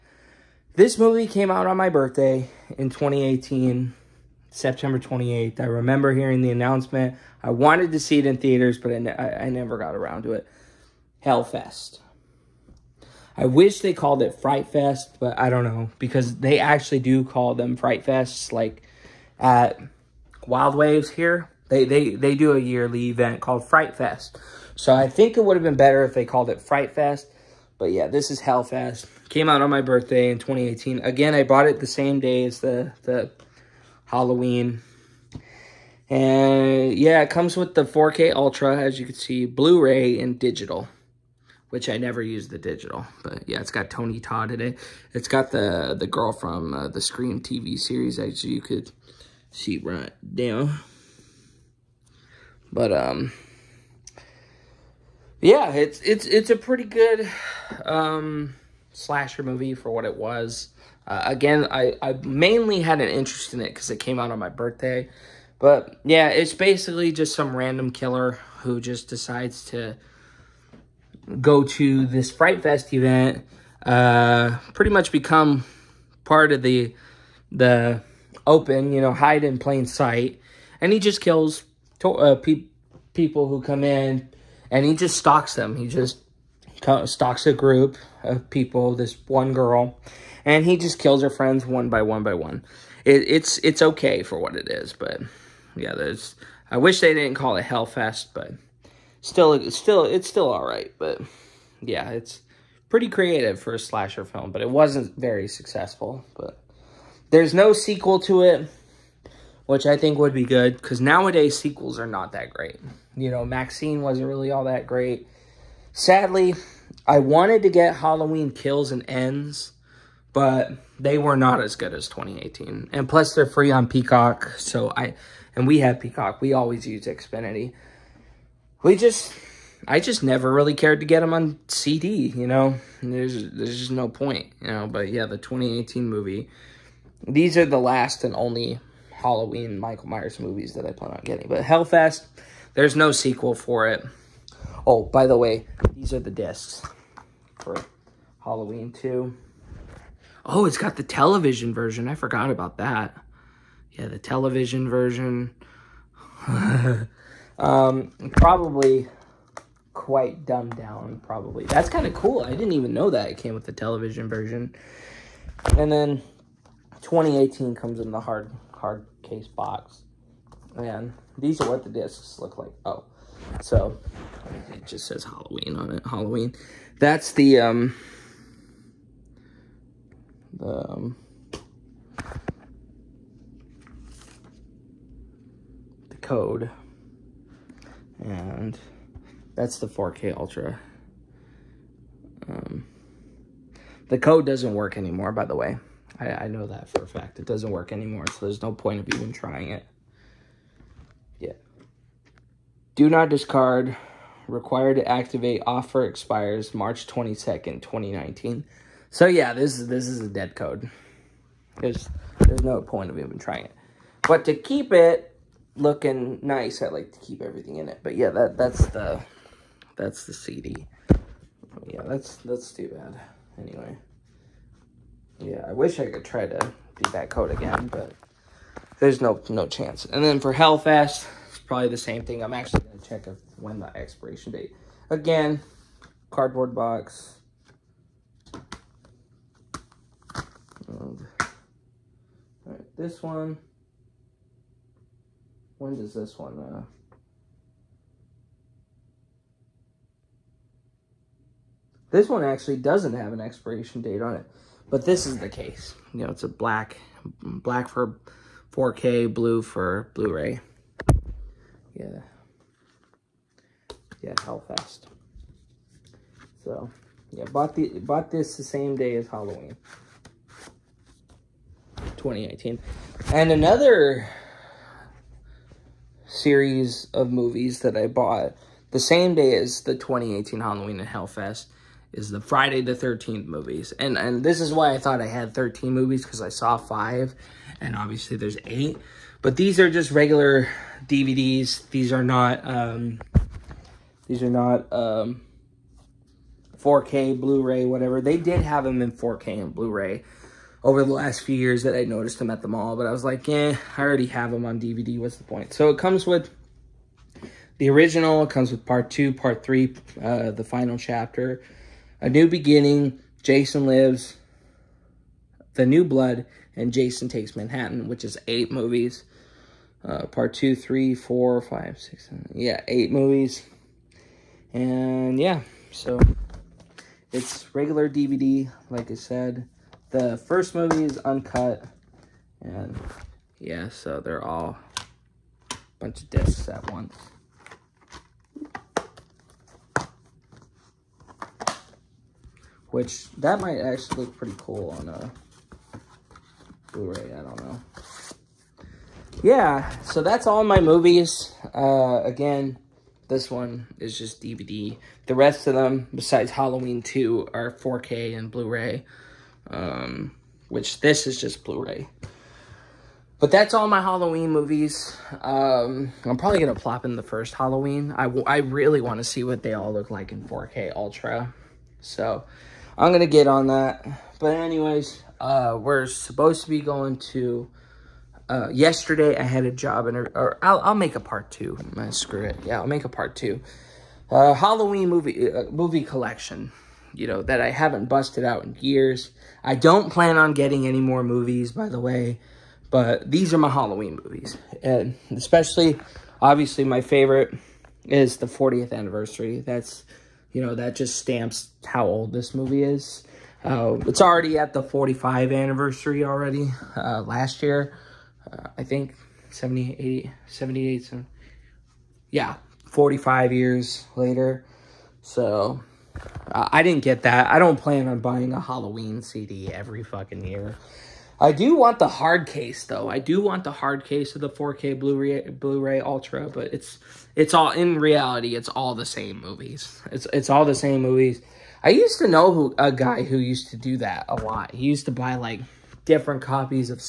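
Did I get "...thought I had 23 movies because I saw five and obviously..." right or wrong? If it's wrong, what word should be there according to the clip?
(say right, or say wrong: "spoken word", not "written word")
wrong: "13", not "23".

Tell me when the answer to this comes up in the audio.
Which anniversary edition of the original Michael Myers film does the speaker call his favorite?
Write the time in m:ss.
6:38.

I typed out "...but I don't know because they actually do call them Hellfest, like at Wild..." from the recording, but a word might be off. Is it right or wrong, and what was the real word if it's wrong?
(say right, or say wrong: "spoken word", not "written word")
wrong: "Frightfests", not "Hellfest".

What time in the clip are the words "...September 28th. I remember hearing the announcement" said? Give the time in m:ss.
0:04.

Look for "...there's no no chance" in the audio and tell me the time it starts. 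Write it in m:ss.
3:48.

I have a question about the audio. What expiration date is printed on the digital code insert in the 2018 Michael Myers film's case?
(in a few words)
March 22nd, 2019.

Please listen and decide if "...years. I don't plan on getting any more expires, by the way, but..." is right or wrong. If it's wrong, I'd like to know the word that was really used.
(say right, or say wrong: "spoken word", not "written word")
wrong: "movies", not "expires".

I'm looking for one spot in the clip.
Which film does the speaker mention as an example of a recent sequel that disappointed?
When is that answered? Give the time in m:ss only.
1:53.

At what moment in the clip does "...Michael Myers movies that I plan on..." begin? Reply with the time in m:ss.
2:19.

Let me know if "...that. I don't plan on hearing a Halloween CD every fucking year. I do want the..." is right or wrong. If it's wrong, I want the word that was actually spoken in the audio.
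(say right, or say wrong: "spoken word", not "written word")
wrong: "buying", not "hearing".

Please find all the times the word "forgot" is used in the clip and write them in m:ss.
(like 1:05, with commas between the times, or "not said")
2:32.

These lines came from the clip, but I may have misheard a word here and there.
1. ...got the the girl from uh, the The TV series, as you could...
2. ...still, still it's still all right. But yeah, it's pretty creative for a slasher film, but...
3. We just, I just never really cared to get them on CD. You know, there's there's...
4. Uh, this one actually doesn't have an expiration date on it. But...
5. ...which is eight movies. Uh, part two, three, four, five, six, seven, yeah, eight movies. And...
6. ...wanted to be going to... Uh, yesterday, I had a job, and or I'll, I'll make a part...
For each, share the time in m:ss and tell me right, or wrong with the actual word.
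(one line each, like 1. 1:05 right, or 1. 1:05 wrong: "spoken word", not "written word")
1. 0:45 wrong: "Scream", not "The"
2. 1:39 right
3. 2:08 right
4. 4:06 right
5. 5:18 right
6. 6:16 wrong: "supposed", not "wanted".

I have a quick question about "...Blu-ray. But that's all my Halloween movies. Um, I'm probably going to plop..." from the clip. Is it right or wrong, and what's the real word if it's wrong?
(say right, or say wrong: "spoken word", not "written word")
right.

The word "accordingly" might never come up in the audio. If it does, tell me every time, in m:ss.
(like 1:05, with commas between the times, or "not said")
not said.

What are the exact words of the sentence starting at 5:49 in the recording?
Yeah, so that's all my movies.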